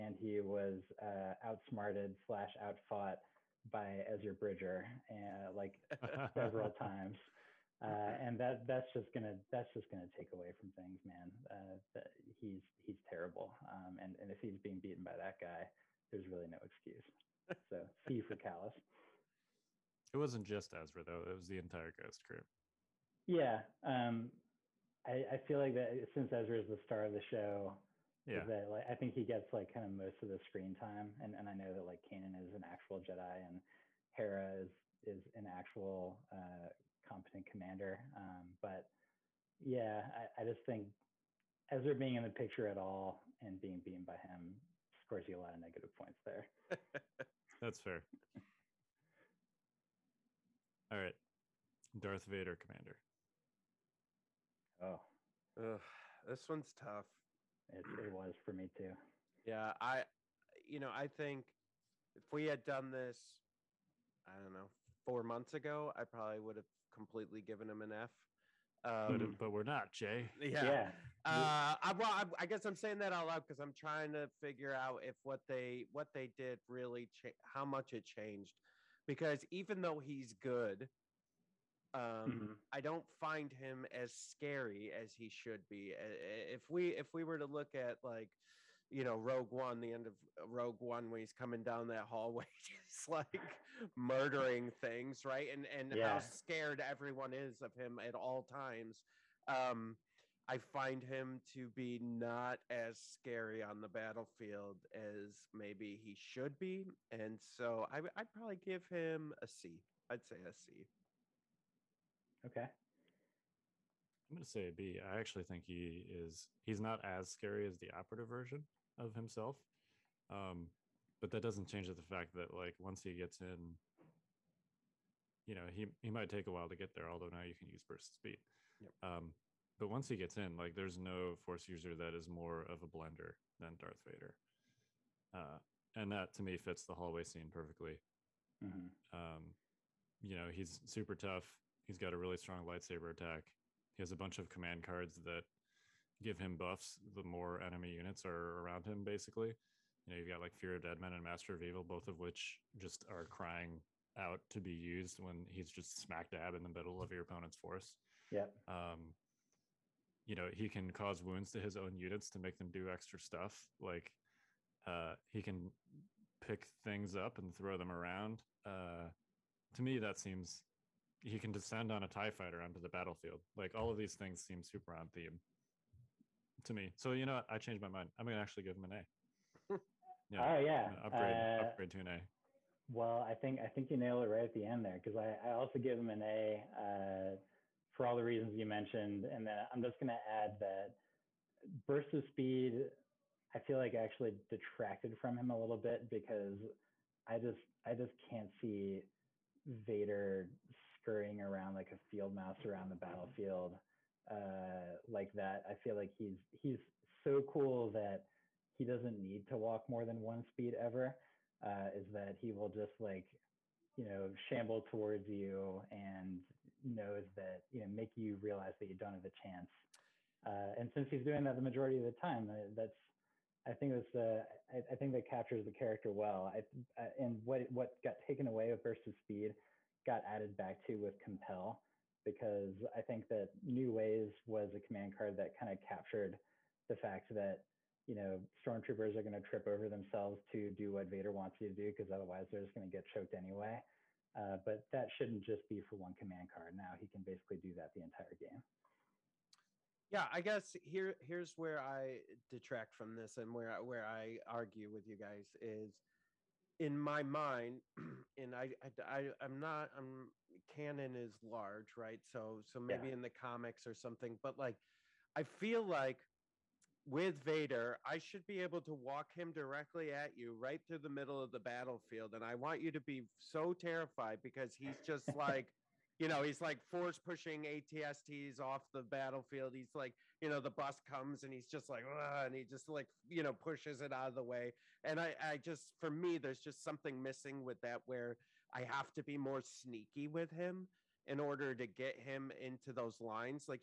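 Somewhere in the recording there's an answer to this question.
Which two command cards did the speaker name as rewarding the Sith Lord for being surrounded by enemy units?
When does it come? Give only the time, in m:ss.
2:30.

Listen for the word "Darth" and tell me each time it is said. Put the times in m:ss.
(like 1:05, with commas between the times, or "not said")
0:51, 2:13.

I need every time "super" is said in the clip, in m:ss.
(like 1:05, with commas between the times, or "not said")
2:20, 2:54.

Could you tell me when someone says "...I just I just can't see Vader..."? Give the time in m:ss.
3:17.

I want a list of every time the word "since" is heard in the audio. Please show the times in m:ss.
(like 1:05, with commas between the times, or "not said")
0:26, 3:40.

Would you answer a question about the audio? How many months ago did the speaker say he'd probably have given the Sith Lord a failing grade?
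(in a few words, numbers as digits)
4.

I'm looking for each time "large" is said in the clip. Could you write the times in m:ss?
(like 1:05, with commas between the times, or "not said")
4:21.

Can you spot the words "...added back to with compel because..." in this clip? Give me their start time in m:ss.
3:50.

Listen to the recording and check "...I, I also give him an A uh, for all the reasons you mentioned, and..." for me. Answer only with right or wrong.
right.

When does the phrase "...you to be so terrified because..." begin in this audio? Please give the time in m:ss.
4:32.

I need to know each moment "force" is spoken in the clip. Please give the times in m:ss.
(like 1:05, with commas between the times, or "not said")
2:11, 2:37, 4:36.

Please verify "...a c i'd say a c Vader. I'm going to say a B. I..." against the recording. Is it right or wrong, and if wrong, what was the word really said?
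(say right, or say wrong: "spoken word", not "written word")
wrong: "Okay", not "Vader".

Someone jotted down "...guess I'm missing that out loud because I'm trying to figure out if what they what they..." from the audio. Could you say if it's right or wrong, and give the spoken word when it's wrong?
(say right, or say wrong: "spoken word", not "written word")
wrong: "saying", not "missing".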